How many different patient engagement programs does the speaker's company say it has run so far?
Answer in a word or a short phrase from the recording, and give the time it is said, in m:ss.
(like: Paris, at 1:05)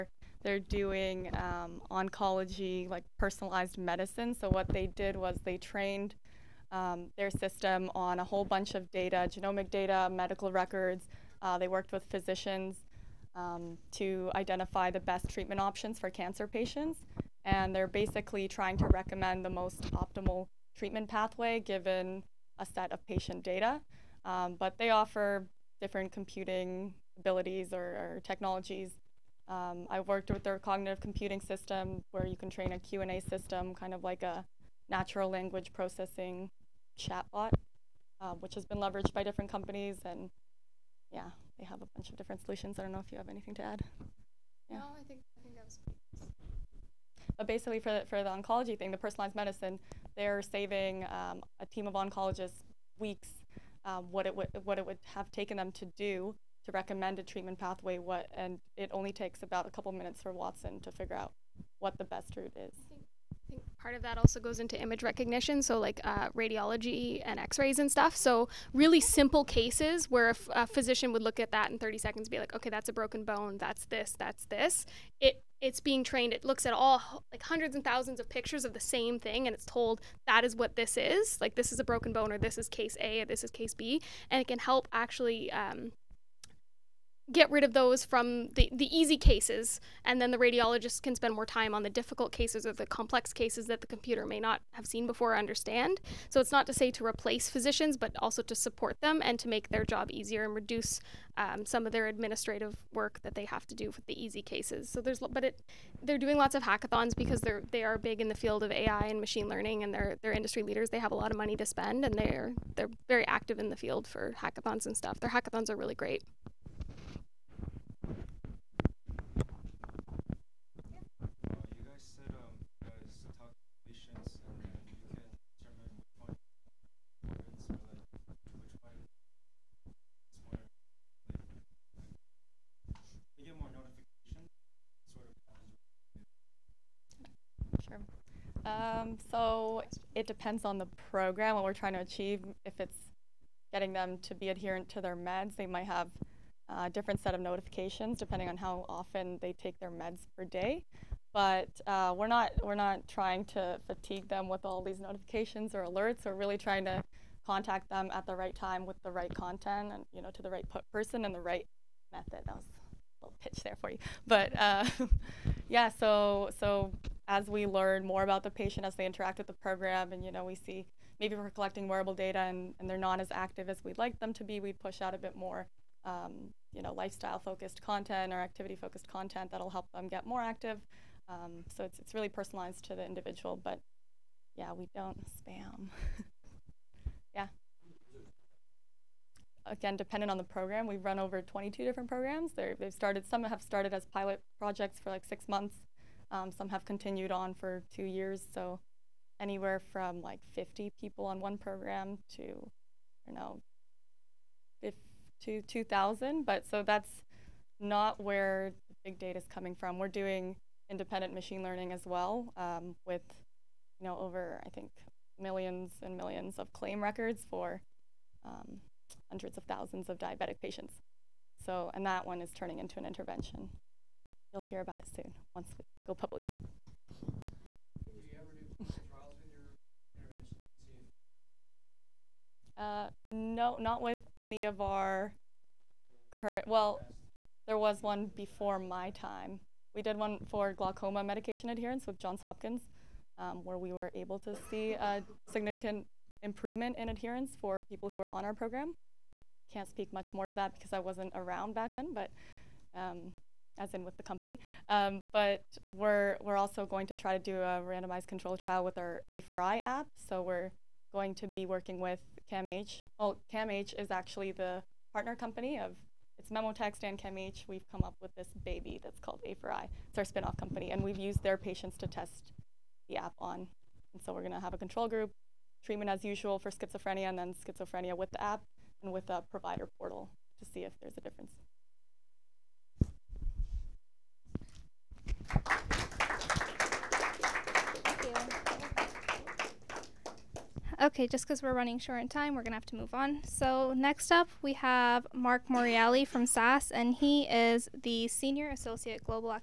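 22, at 3:11.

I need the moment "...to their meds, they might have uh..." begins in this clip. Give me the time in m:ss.
2:24.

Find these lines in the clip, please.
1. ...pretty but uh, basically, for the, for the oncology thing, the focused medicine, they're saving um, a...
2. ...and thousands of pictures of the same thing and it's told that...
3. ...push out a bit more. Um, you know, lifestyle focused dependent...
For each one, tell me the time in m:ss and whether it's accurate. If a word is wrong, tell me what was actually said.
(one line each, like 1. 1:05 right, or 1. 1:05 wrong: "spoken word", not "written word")
1. 0:45 wrong: "personalized", not "focused"
2. 1:17 right
3. 2:54 wrong: "content", not "dependent".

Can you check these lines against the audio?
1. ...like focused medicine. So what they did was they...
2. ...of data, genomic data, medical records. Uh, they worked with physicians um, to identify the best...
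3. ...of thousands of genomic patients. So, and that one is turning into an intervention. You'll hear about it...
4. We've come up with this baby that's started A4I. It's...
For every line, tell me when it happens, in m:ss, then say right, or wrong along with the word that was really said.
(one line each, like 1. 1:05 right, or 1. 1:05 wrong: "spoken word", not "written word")
1. 0:02 wrong: "personalized", not "focused"
2. 0:08 right
3. 3:39 wrong: "diabetic", not "genomic"
4. 4:27 wrong: "called", not "started".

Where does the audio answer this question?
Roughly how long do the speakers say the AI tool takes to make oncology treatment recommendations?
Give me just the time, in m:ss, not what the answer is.
0:59.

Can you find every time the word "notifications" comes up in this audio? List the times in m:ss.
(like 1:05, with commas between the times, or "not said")
2:27, 2:35.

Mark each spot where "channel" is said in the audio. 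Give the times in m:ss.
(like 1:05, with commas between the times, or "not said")
not said.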